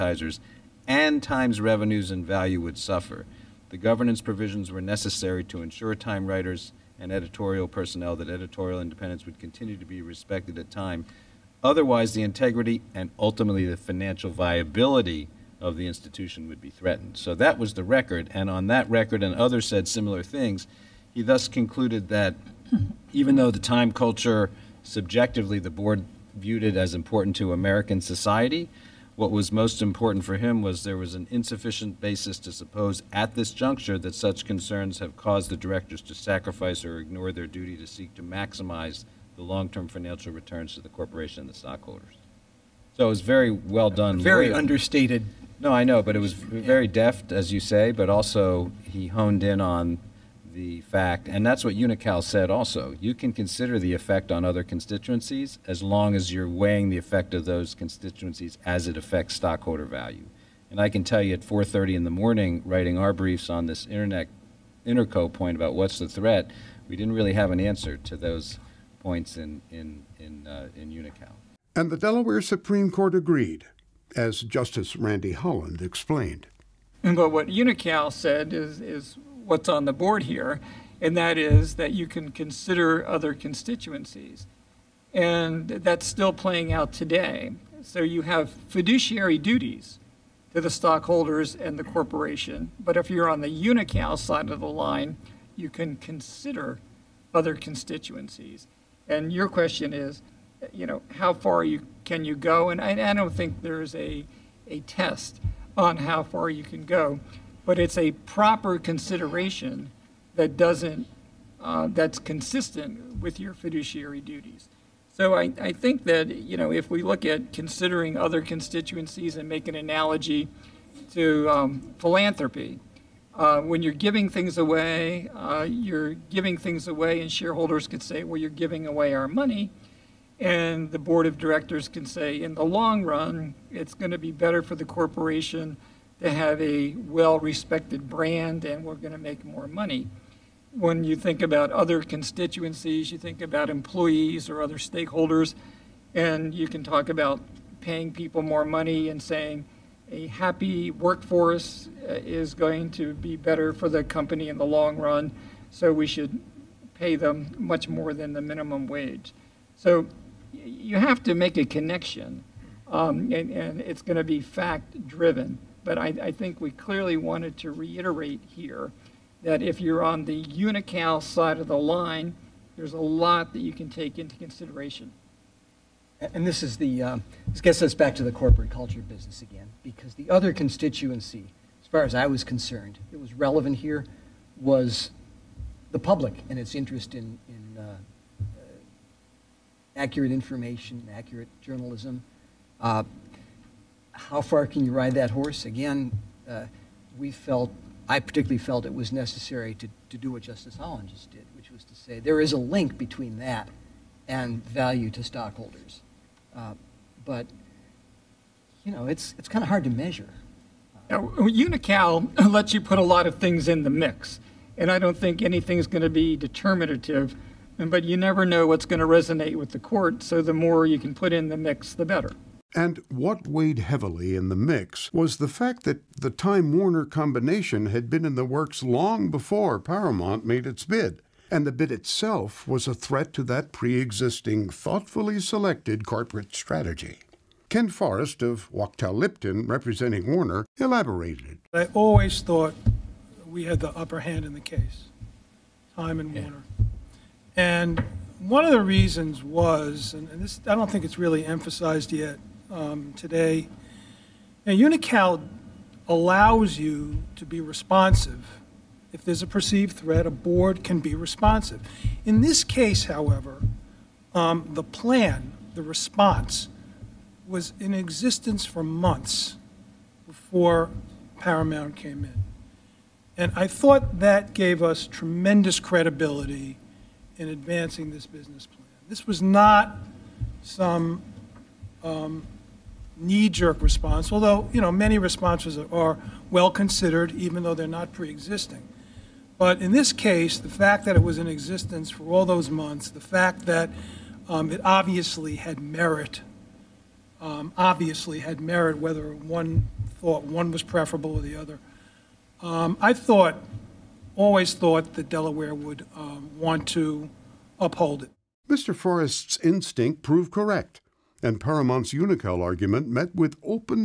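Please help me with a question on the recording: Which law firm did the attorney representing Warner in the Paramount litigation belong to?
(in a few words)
Wachtell Lipton.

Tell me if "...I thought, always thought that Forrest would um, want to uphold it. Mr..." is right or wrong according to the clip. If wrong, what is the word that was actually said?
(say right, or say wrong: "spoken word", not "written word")
wrong: "Delaware", not "Forrest".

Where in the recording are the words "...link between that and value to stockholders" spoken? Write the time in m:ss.
3:22.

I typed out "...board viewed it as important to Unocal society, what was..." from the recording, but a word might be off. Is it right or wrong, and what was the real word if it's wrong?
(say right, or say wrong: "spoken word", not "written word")
wrong: "American", not "Unocal".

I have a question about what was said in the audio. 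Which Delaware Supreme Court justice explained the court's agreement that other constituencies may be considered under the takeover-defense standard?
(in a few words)
Randy Holland.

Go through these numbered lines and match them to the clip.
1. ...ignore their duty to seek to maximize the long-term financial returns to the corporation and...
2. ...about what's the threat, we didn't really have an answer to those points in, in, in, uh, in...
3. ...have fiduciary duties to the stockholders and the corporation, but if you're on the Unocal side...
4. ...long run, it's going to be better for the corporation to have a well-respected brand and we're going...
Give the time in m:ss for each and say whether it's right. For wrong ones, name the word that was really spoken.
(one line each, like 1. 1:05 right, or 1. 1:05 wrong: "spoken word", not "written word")
1. 0:36 right
2. 1:05 right
3. 1:28 right
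4. 2:12 right.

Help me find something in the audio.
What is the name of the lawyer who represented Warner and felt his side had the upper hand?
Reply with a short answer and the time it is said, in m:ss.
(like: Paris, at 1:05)
Ken Forrest, at 3:57.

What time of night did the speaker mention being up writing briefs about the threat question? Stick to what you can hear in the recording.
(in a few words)
4:30 in the morning.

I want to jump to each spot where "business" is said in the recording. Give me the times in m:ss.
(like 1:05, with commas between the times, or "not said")
2:59, 4:38.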